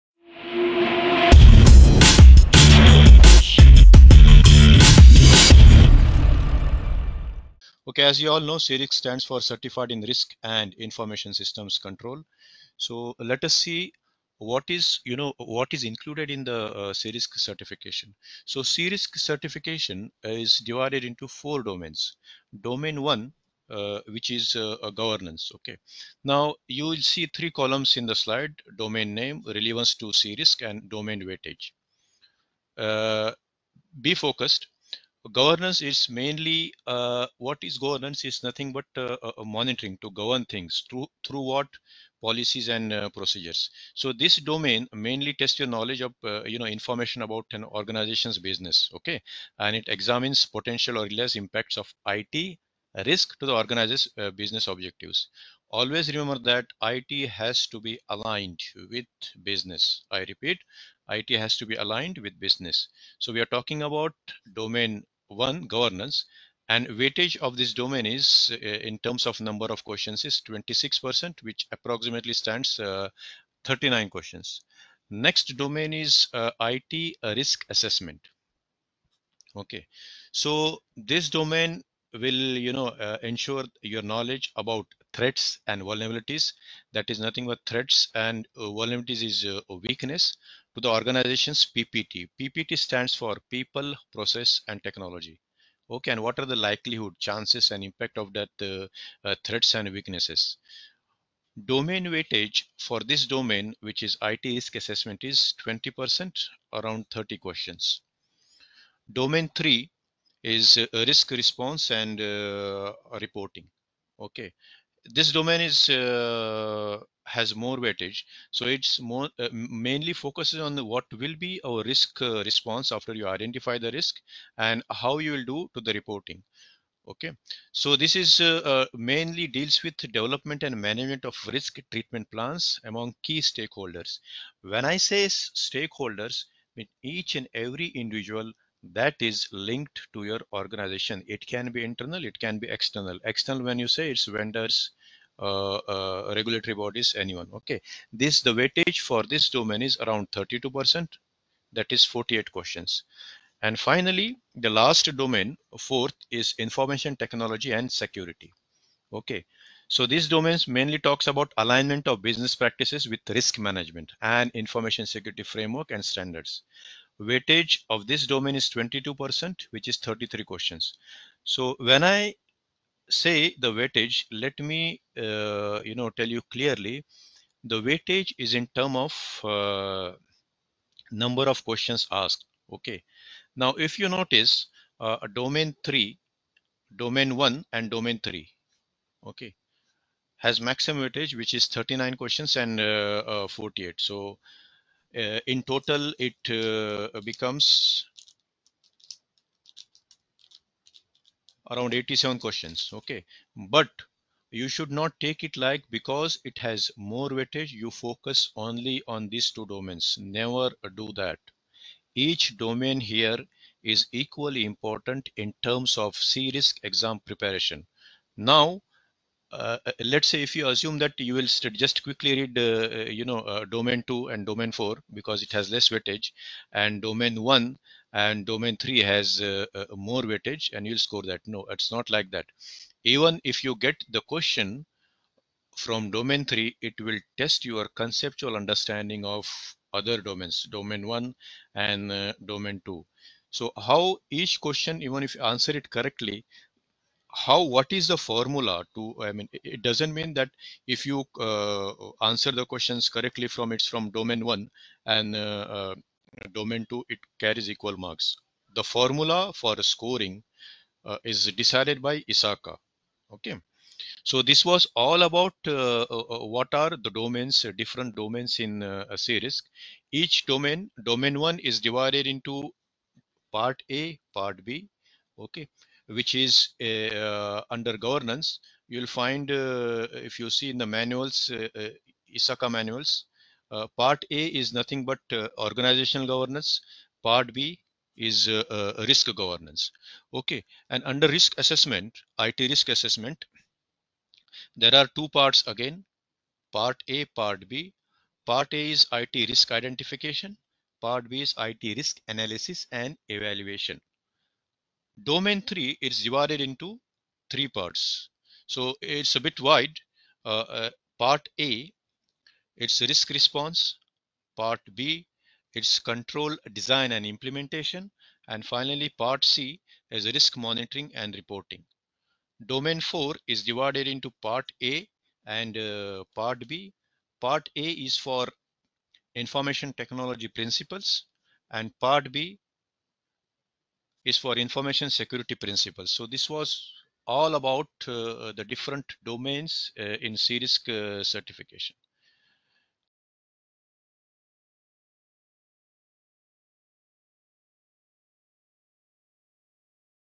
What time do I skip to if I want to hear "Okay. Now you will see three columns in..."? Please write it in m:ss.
0:25.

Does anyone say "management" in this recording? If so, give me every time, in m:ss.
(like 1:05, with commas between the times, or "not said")
2:10, 2:43.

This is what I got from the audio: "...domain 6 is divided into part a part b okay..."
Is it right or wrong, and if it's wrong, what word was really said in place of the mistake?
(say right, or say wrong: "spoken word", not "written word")
wrong: "1", not "6".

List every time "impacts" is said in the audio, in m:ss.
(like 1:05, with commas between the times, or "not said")
0:51, 1:37.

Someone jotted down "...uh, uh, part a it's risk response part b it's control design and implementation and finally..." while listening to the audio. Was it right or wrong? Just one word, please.
right.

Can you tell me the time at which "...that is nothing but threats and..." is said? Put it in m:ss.
1:26.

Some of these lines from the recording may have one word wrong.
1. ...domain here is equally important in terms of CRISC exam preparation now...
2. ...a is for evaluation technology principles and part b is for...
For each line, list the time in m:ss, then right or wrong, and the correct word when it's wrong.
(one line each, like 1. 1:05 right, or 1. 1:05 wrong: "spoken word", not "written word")
1. 3:32 right
2. 5:27 wrong: "information", not "evaluation".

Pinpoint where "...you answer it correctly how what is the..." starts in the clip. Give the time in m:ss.
4:05.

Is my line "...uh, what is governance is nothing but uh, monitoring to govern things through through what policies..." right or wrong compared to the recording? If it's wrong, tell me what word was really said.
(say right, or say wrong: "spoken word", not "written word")
right.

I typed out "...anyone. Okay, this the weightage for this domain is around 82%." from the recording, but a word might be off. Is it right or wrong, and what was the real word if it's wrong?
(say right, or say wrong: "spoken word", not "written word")
wrong: "32", not "82".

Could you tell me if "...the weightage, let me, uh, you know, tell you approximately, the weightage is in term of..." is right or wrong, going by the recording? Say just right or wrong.
wrong.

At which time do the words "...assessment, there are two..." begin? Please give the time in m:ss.
4:52.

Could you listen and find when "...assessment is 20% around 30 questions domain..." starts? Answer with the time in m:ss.
1:44.